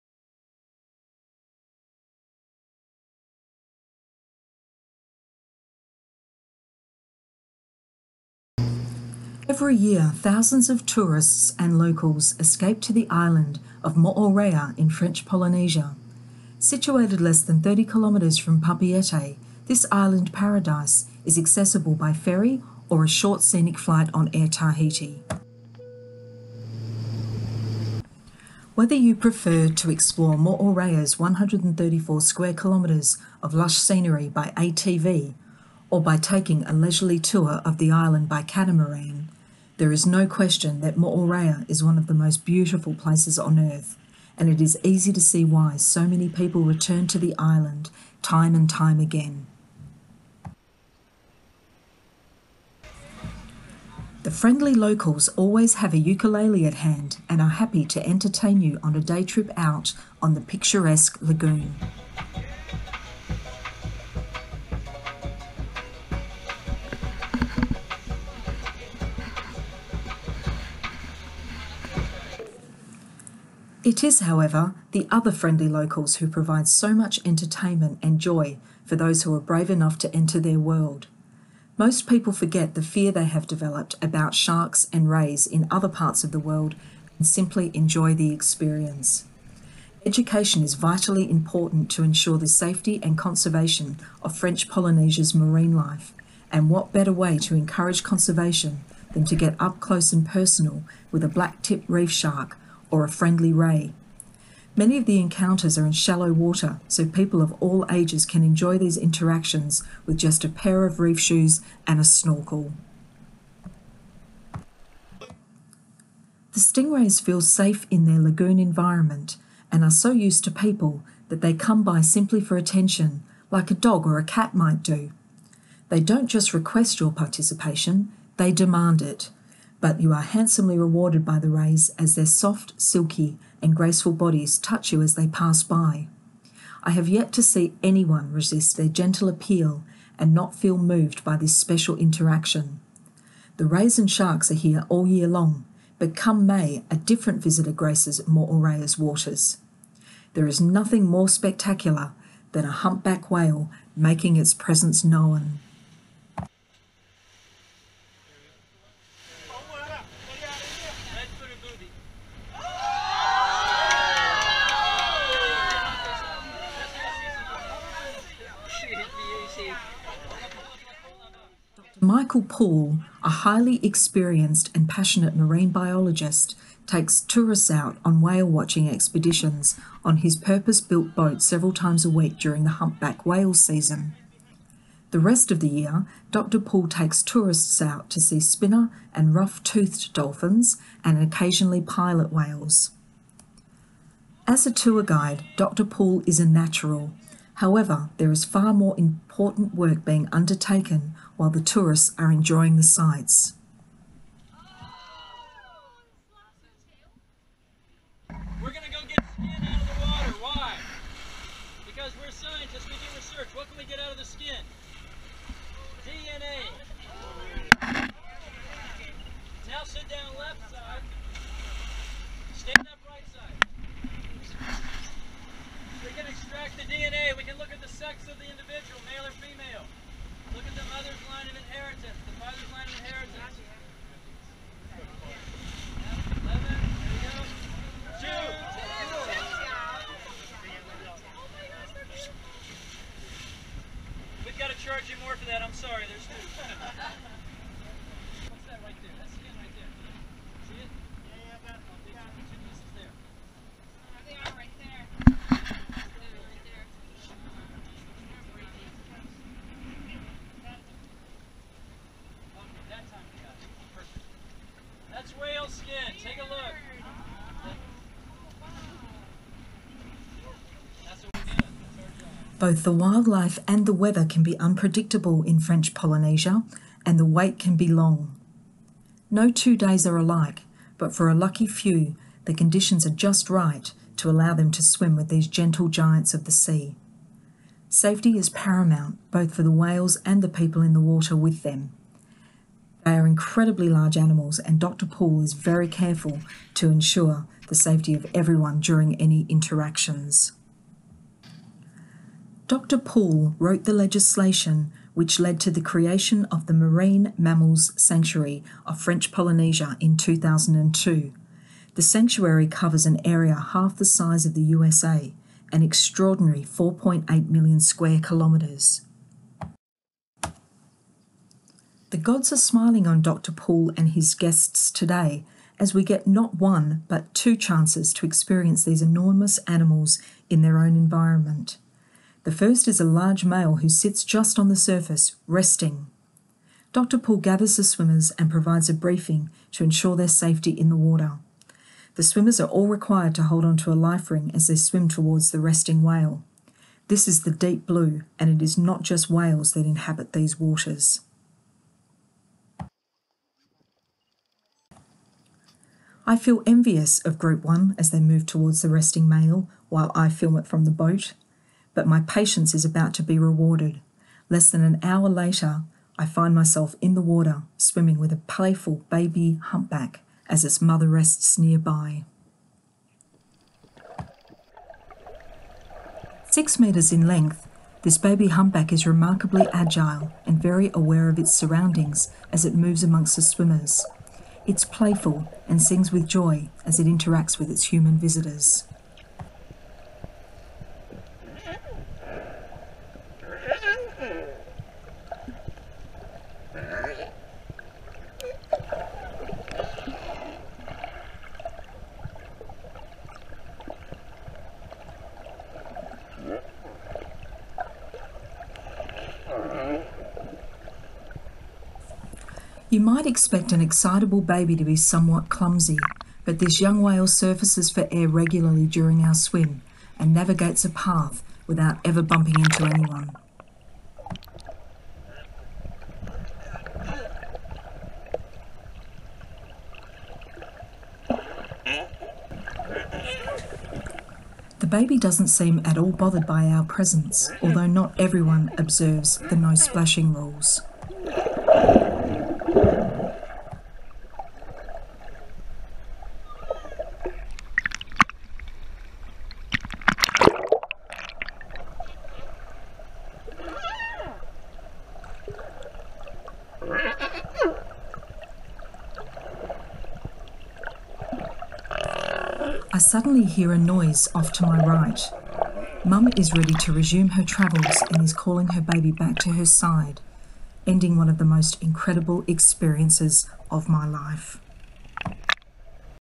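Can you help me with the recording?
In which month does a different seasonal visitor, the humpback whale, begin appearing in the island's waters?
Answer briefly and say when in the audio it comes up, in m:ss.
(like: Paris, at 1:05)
May, at 2:26.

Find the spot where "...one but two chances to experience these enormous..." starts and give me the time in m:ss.
5:26.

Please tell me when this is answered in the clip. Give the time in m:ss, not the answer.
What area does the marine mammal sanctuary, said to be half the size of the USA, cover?
5:16.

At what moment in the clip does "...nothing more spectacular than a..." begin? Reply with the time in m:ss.
2:30.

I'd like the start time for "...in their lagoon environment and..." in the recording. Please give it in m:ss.
1:57.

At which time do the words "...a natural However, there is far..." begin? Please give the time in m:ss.
3:16.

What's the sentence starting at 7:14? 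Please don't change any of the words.
The baby doesn't seem at all bothered by our presence, although not everyone observes the no splashing rules.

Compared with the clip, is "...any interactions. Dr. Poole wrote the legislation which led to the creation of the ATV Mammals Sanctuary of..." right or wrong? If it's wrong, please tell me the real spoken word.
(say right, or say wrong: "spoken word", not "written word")
wrong: "Marine", not "ATV".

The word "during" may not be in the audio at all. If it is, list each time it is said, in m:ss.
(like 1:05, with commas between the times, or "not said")
3:02, 4:58, 6:58.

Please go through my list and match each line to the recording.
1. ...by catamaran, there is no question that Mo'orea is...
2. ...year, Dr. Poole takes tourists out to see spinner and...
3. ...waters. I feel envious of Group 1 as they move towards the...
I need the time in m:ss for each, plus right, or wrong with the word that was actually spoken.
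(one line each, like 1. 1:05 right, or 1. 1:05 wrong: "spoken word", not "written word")
1. 0:38 right
2. 3:05 right
3. 5:50 right.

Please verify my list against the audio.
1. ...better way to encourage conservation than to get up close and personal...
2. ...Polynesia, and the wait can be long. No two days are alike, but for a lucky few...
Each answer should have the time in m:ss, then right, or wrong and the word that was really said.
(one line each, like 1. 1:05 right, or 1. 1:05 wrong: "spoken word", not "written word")
1. 1:36 right
2. 4:35 right.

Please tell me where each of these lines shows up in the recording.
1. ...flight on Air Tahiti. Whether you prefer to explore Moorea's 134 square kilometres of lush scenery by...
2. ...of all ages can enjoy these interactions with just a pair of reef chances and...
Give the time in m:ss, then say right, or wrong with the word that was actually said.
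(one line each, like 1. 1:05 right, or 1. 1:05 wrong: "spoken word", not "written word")
1. 0:23 right
2. 1:47 wrong: "shoes", not "chances".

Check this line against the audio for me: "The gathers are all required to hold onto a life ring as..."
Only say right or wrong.
wrong.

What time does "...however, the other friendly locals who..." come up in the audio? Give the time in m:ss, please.
1:14.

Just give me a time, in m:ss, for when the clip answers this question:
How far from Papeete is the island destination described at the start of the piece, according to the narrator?
0:17.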